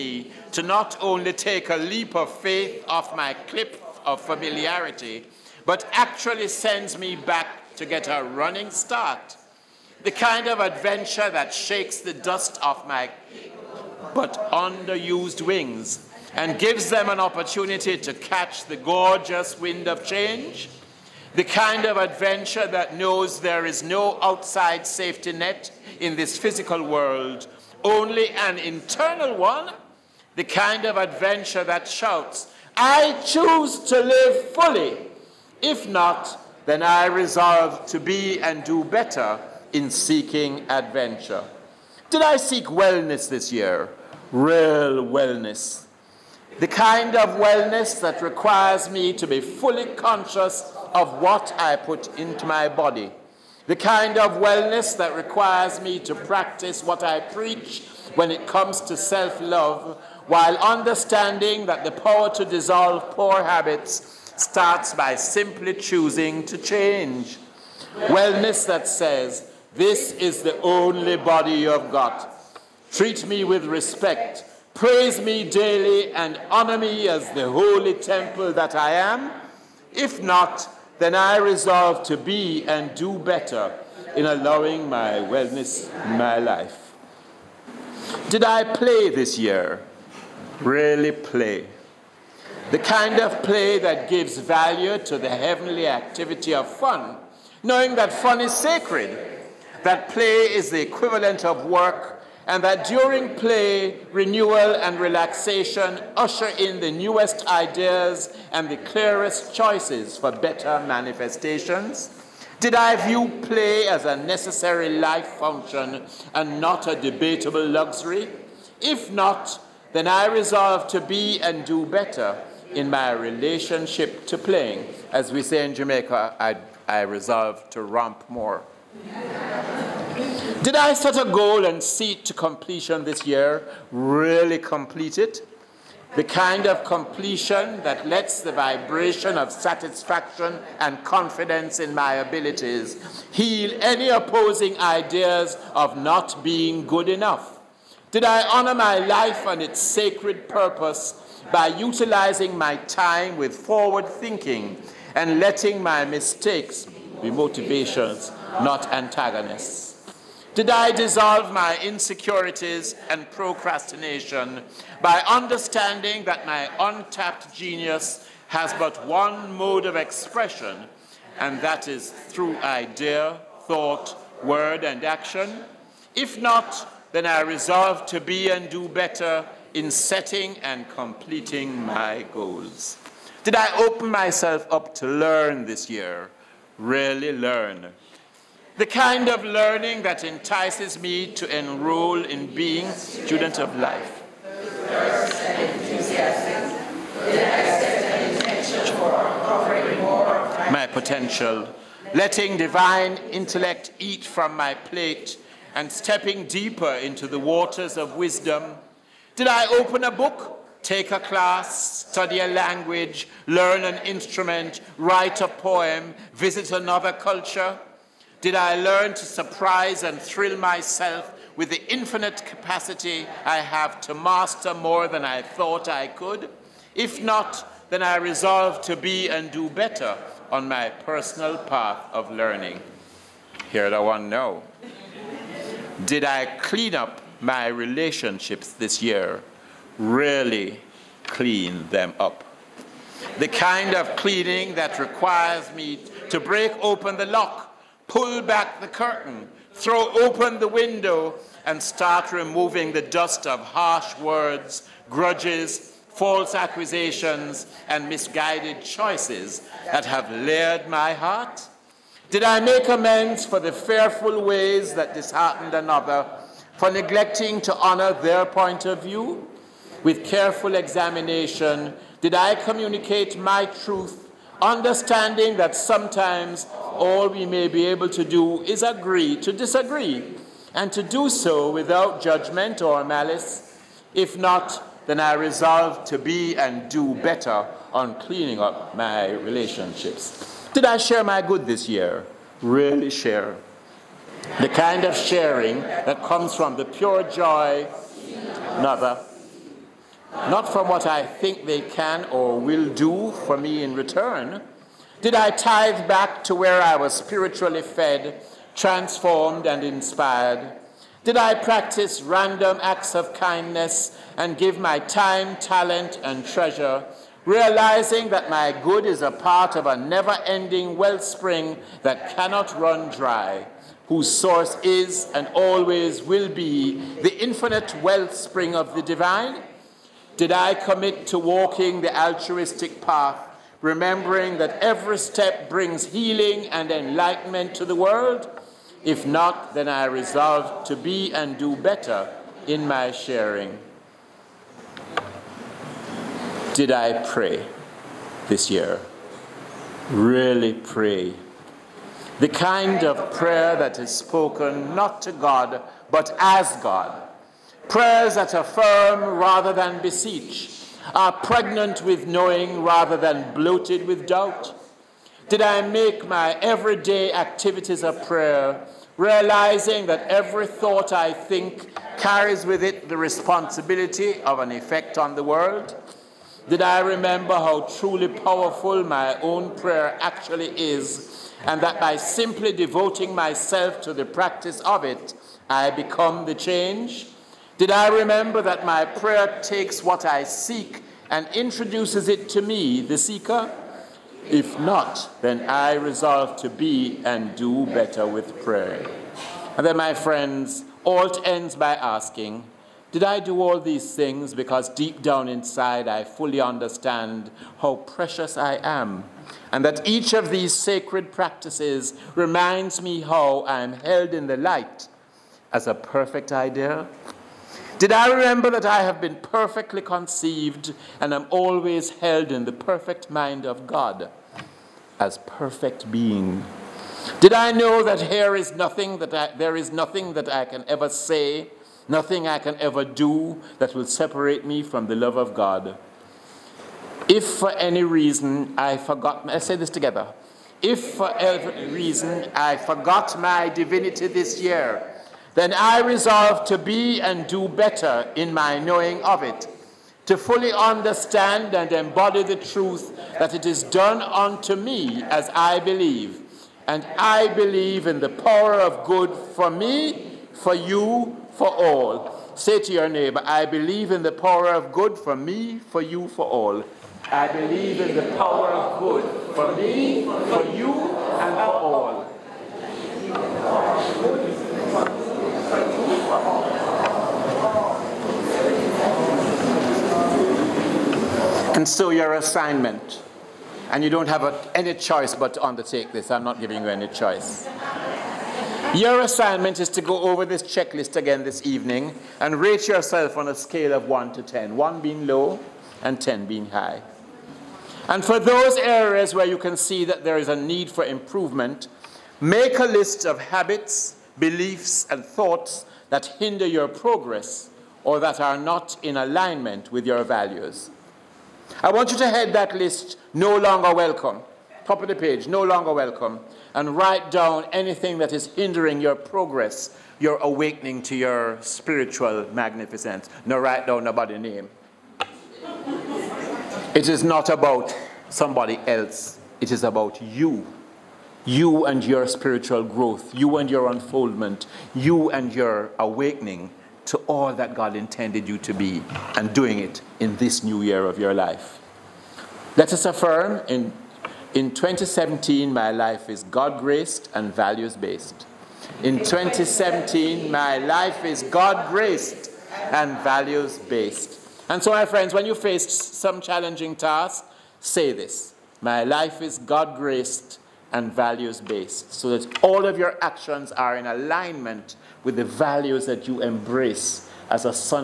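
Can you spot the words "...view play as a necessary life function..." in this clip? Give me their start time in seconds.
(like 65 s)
113 s.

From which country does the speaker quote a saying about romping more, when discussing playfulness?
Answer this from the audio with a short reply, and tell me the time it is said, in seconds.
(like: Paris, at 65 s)
Jamaica, at 125 s.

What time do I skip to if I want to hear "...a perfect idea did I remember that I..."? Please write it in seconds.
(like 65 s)
415 s.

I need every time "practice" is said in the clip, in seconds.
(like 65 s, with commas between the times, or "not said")
56 s, 311 s, 384 s, 411 s.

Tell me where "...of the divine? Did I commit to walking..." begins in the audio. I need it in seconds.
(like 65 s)
328 s.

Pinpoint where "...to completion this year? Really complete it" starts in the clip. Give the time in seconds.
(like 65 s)
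132 s.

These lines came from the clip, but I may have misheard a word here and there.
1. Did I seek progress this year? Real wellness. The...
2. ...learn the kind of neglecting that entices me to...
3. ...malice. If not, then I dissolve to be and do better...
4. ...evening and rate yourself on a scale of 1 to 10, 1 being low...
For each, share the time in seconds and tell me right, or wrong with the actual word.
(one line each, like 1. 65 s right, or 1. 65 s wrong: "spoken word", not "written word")
1. 42 s wrong: "wellness", not "progress"
2. 187 s wrong: "learning", not "neglecting"
3. 283 s wrong: "resolve", not "dissolve"
4. 491 s right.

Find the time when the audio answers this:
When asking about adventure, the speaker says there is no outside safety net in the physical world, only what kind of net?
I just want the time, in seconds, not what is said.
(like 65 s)
28 s.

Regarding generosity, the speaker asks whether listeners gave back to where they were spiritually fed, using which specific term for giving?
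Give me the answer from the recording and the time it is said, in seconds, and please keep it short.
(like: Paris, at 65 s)
tithe, at 305 s.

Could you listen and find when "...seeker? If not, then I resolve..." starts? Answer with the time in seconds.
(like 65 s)
393 s.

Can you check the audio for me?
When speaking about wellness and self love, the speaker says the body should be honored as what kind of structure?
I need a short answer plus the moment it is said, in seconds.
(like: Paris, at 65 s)
holy temple, at 77 s.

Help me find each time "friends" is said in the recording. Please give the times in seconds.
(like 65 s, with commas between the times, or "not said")
400 s, 555 s.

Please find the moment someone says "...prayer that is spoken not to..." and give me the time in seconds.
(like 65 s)
353 s.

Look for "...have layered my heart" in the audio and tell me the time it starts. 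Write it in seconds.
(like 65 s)
260 s.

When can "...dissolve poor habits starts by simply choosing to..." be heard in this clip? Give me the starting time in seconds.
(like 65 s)
62 s.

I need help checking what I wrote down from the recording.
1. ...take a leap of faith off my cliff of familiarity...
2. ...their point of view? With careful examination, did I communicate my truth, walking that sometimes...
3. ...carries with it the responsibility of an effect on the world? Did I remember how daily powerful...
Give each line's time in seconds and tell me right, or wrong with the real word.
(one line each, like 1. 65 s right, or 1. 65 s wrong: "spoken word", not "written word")
1. 1 s right
2. 268 s wrong: "understanding", not "walking"
3. 372 s wrong: "truly", not "daily".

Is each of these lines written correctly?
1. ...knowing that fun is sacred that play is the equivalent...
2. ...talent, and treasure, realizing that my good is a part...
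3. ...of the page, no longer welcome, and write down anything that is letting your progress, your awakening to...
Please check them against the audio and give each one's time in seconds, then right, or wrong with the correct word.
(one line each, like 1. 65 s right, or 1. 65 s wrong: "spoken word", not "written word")
1. 97 s right
2. 315 s right
3. 515 s wrong: "hindering", not "letting".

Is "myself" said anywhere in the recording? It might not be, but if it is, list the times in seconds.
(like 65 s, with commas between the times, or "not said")
184 s, 220 s, 383 s.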